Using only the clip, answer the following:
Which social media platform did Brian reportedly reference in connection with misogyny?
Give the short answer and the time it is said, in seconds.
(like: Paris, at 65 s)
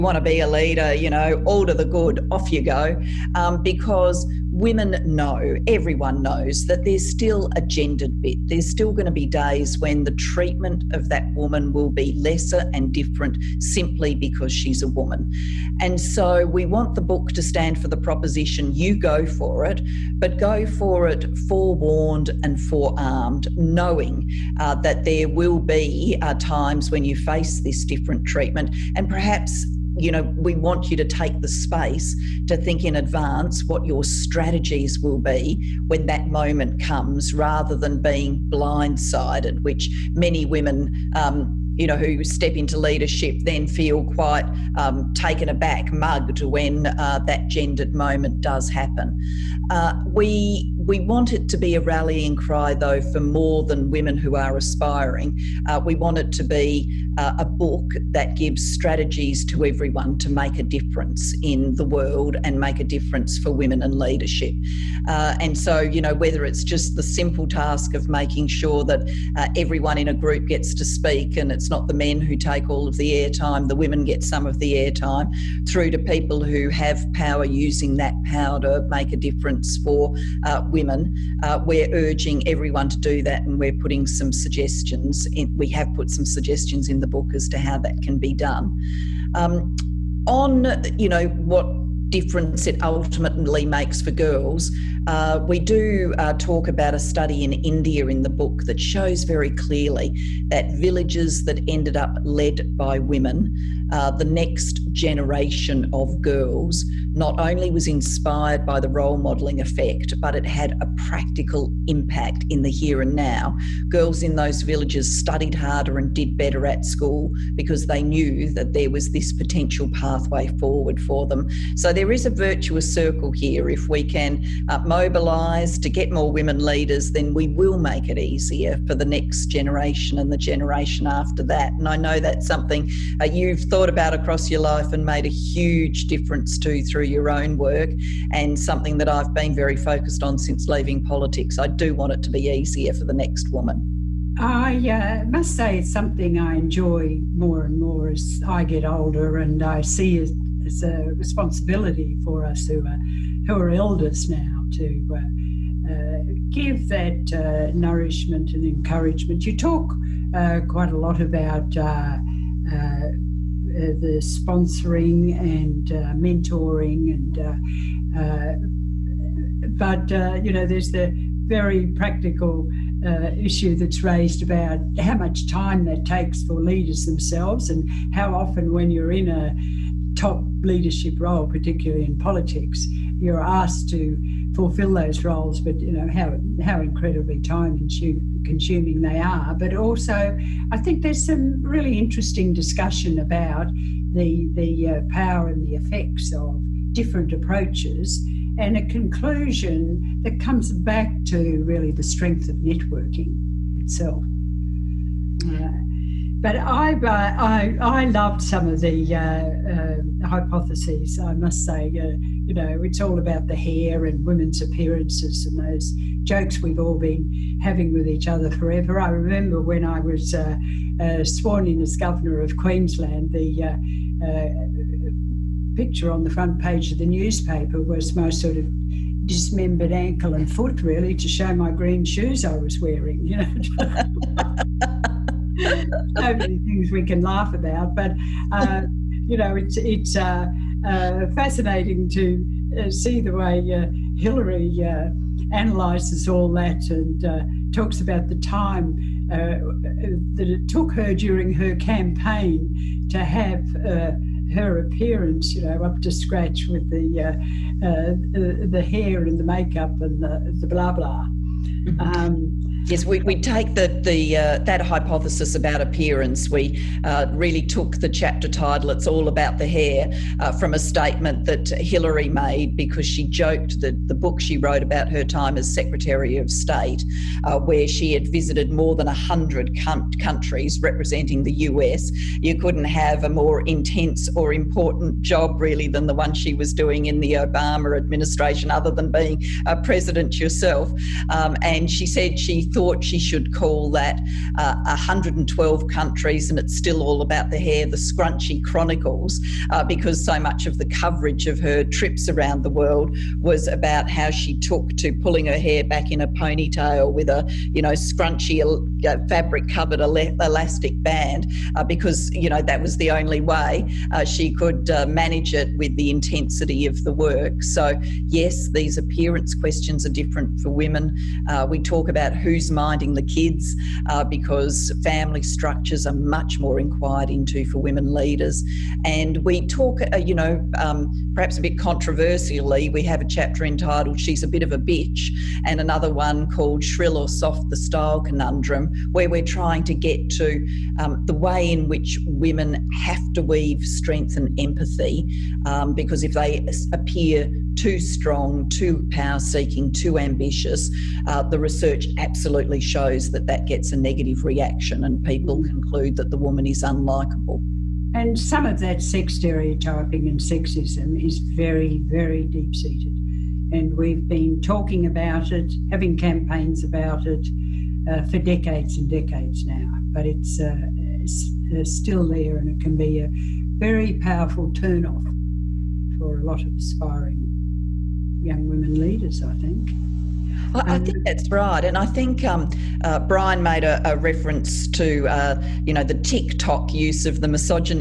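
TikTok, at 386 s.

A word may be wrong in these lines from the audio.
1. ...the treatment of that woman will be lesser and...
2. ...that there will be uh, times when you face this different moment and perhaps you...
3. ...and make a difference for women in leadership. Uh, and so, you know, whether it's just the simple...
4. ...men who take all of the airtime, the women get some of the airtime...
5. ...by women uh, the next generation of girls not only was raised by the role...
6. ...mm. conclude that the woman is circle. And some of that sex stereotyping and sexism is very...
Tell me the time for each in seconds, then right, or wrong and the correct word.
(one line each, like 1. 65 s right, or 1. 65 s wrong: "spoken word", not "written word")
1. 10 s right
2. 24 s wrong: "treatment", not "moment"
3. 62 s right
4. 71 s right
5. 102 s wrong: "inspired", not "raised"
6. 355 s wrong: "unlikable", not "circle".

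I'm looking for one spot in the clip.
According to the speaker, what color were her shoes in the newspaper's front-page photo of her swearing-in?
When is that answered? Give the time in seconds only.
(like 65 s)
231 s.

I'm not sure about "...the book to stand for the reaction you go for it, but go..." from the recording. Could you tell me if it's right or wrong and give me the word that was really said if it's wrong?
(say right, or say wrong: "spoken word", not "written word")
wrong: "proposition", not "reaction".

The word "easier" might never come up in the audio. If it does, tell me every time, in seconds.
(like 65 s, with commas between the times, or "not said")
128 s, 142 s.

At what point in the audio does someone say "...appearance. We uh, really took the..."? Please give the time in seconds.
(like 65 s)
265 s.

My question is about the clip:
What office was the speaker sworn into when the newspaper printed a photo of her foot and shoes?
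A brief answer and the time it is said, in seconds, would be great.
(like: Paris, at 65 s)
Governor of Queensland, at 221 s.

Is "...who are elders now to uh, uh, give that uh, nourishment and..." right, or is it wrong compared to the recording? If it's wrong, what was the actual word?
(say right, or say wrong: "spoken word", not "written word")
right.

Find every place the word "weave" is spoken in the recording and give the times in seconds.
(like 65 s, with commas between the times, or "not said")
343 s.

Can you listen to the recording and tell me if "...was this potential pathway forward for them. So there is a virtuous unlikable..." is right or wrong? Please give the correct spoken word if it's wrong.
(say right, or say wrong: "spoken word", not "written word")
wrong: "circle", not "unlikable".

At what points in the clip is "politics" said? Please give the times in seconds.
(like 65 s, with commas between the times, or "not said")
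141 s, 182 s.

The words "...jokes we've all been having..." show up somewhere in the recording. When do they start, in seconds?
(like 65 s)
216 s.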